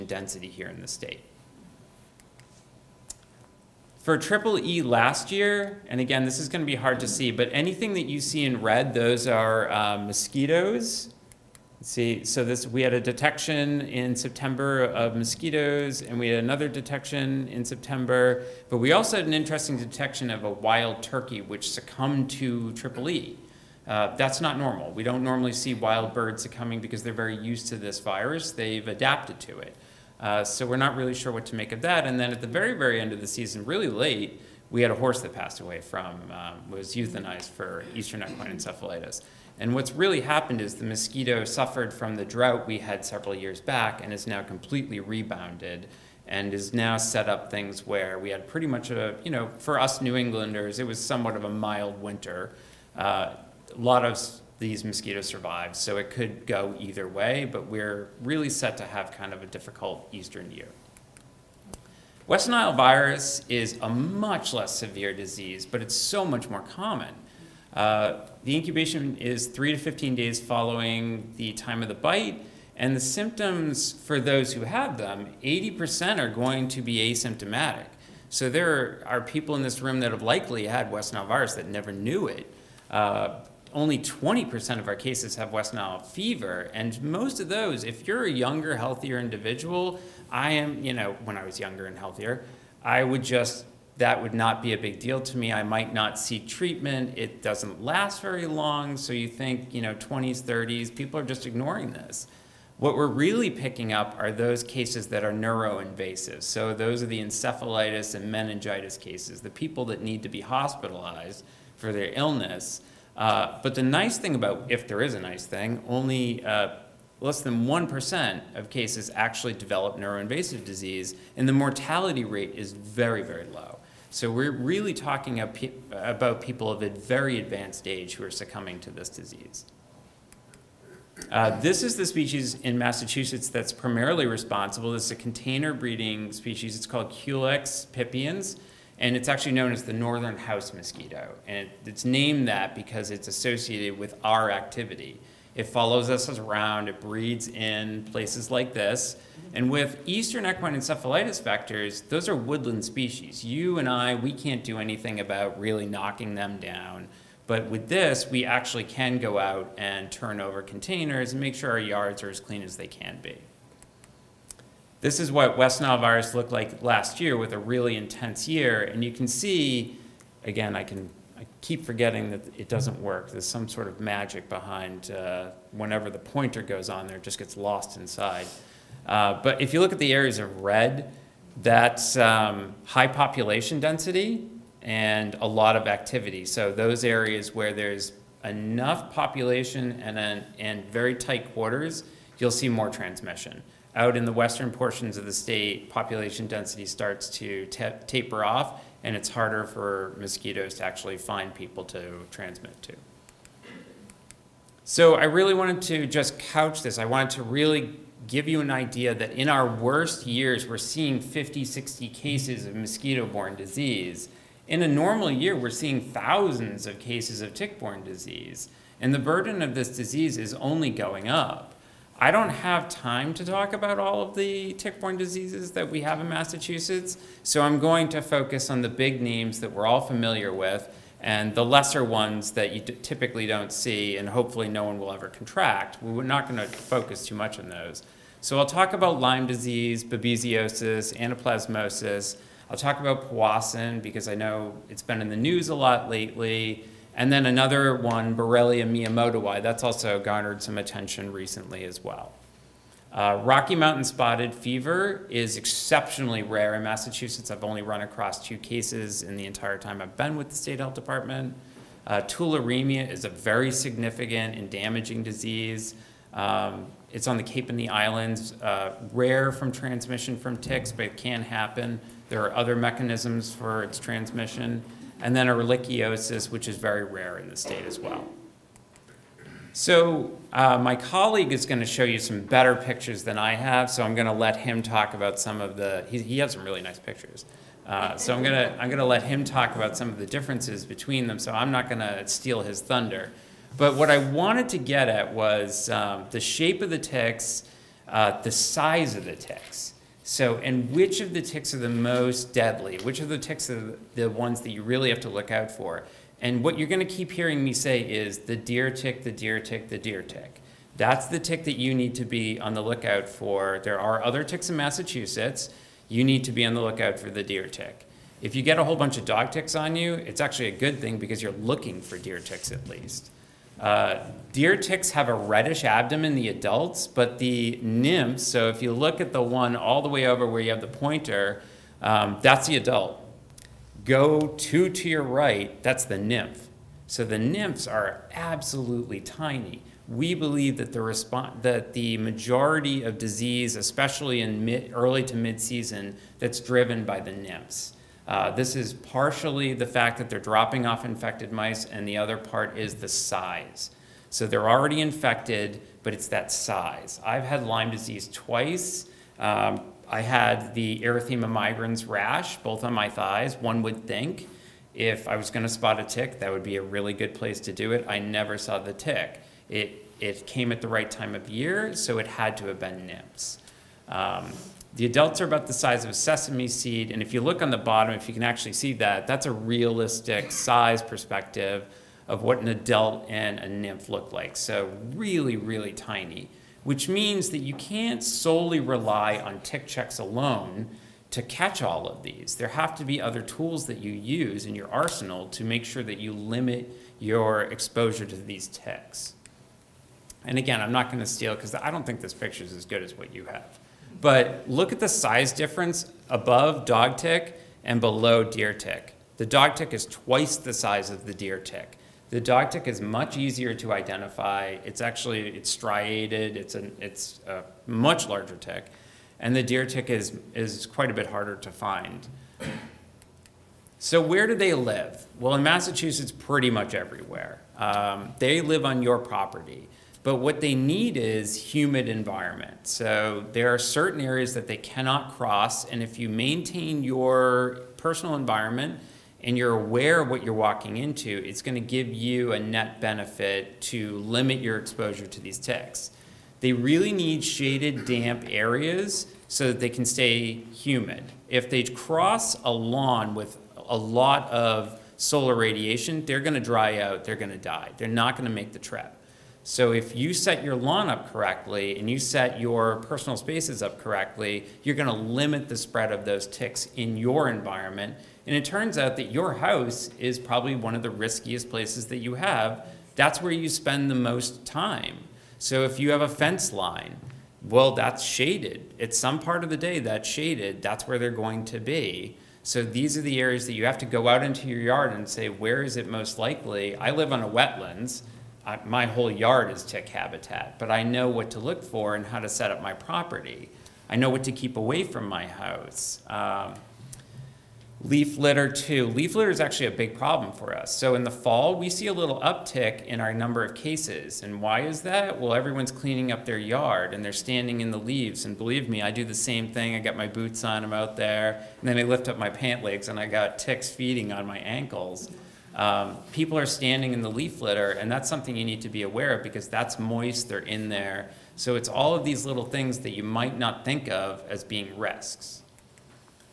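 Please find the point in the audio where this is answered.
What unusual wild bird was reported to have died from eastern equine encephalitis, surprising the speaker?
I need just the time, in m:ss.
0:20.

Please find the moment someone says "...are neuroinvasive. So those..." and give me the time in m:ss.
1:45.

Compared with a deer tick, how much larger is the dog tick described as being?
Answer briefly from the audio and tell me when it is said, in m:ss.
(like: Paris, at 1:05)
twice the size, at 6:50.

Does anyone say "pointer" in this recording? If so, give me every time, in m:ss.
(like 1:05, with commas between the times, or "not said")
2:56, 5:30.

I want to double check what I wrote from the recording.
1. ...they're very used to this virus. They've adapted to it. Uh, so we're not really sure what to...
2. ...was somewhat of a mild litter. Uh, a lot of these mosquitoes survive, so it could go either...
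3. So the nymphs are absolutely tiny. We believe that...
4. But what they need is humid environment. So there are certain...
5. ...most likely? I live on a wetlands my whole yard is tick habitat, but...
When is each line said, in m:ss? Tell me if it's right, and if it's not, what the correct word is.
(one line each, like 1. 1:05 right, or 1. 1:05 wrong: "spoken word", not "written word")
1. 0:27 right
2. 0:50 wrong: "winter", not "litter"
3. 5:37 right
4. 7:10 right
5. 8:06 right.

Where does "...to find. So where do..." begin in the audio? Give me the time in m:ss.
7:01.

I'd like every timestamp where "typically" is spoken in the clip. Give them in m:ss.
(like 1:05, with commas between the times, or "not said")
3:52.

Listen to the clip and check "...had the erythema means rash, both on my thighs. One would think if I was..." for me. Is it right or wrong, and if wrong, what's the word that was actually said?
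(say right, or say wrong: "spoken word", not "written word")
wrong: "migrans", not "means".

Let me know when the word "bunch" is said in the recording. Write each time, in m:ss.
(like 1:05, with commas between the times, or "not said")
5:18.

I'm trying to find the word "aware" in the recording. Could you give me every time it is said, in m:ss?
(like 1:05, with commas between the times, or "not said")
7:19, 8:39.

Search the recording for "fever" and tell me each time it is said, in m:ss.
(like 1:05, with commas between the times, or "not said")
1:26, 4:14.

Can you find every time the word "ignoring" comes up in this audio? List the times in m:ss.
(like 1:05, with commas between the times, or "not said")
1:41.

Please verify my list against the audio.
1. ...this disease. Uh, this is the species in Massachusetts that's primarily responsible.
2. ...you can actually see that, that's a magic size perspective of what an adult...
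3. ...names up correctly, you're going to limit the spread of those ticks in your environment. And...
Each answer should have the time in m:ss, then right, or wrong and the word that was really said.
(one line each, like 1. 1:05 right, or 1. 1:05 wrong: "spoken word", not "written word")
1. 2:08 right
2. 6:18 wrong: "realistic", not "magic"
3. 7:43 wrong: "spaces", not "names".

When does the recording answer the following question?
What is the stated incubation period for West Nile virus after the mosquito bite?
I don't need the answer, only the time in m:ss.
1:09.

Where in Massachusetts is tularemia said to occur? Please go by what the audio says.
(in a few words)
the Cape and the Islands.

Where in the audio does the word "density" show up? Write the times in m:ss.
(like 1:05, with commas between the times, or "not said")
0:00, 3:03, 3:16.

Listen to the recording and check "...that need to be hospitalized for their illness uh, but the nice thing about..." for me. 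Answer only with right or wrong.
right.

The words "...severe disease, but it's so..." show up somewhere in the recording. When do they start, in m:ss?
1:04.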